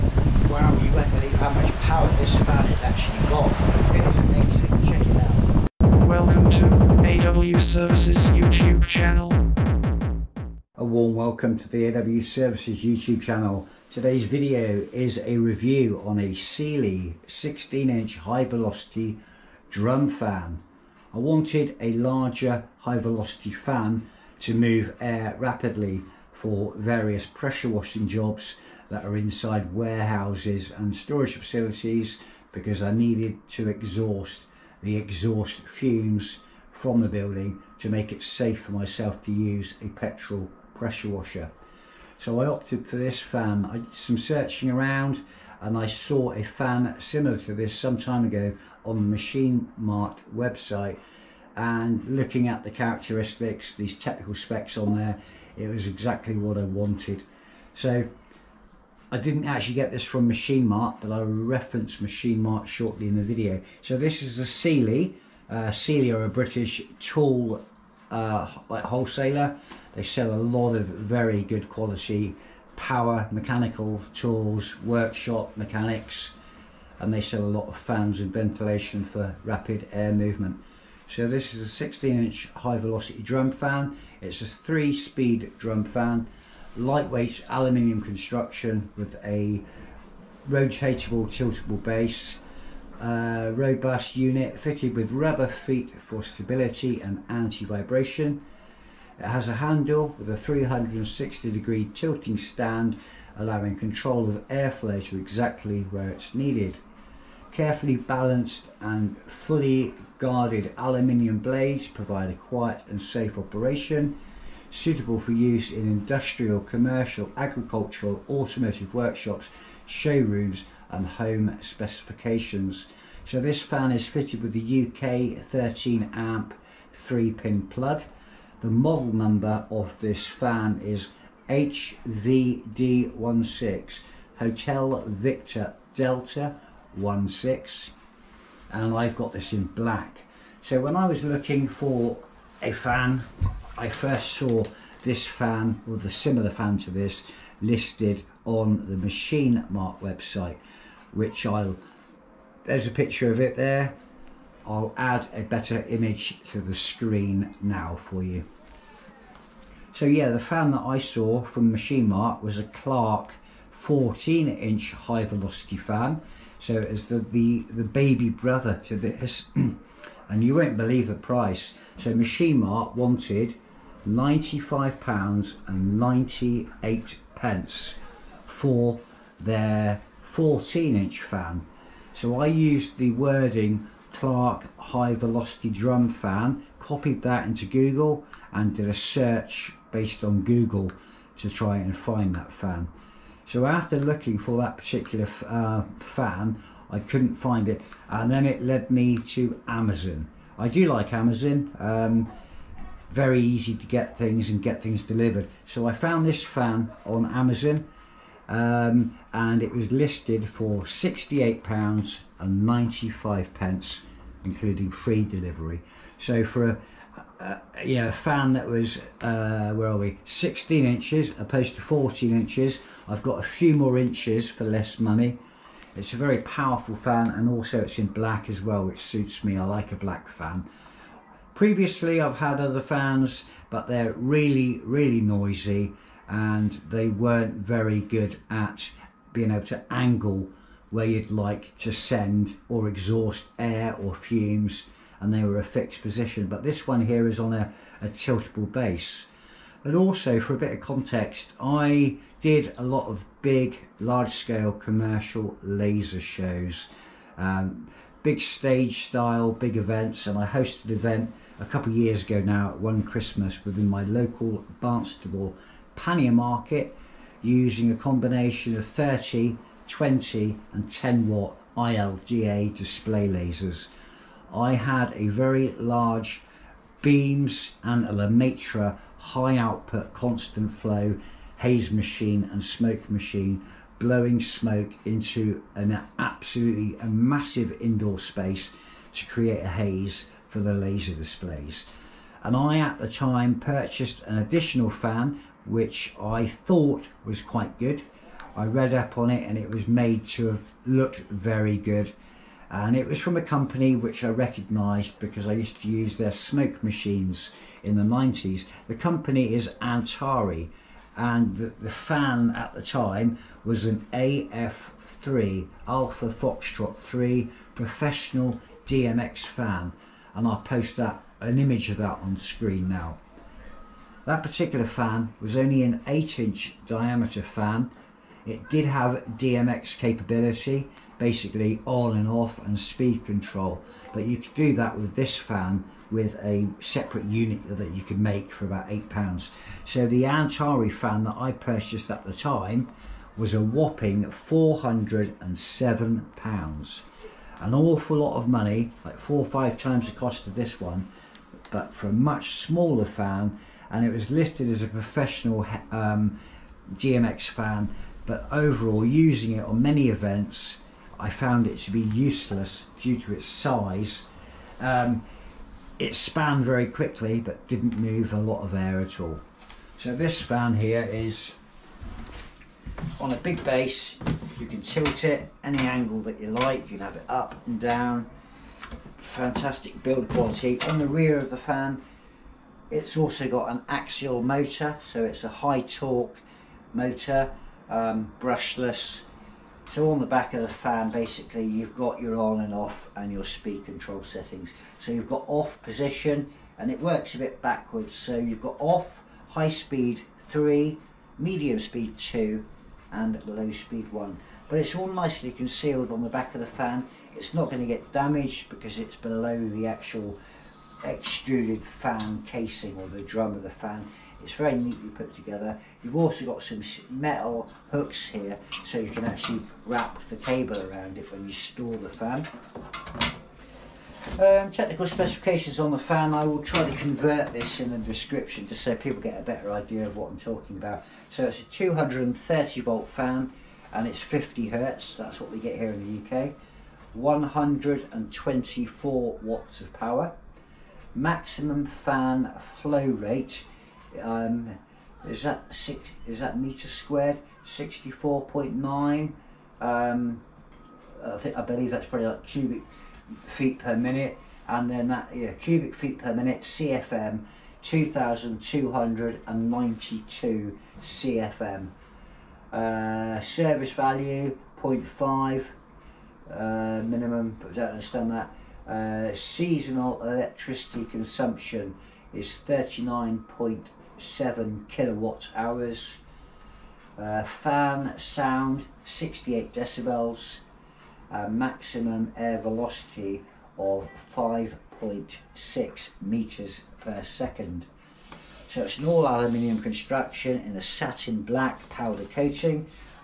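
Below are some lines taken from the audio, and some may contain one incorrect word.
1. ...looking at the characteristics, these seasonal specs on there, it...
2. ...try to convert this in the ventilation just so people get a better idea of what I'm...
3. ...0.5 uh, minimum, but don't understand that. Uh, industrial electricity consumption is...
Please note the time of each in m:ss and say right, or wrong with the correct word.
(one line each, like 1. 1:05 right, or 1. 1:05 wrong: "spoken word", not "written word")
1. 0:52 wrong: "technical", not "seasonal"
2. 7:06 wrong: "description", not "ventilation"
3. 7:44 wrong: "seasonal", not "industrial".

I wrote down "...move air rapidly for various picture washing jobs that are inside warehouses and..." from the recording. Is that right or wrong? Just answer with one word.
wrong.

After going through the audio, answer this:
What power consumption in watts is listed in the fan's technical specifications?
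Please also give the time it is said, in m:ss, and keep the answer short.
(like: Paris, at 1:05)
124 watts, at 7:17.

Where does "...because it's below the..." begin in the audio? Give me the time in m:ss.
6:48.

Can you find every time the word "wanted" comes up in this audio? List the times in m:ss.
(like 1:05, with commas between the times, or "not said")
0:21, 0:56, 2:52.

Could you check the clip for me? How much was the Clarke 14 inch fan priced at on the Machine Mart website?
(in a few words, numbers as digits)
£95.98.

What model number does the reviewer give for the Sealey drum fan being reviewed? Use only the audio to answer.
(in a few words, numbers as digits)
HVD16.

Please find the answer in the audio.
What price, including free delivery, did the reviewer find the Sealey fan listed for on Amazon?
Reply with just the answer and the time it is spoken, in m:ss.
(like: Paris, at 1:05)
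£68.95, at 3:30.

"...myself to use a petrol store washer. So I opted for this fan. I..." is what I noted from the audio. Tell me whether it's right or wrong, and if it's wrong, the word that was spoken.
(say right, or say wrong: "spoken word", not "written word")
wrong: "pressure", not "store".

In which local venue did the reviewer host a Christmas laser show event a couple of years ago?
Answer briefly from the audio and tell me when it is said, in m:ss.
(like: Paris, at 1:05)
Barnstaple pannier market, at 4:24.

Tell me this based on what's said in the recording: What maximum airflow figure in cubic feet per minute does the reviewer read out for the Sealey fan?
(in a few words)
2,292 CFM.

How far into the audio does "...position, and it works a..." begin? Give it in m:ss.
6:35.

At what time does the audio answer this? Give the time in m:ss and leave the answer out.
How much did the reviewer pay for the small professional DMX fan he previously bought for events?
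5:44.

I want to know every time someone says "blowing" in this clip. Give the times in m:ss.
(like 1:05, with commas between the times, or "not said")
4:43.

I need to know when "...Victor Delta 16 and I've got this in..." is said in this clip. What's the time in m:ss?
2:15.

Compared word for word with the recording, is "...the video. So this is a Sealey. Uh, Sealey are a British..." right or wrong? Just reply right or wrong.
right.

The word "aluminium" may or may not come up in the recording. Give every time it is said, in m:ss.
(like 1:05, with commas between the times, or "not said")
1:27, 1:50, 8:09.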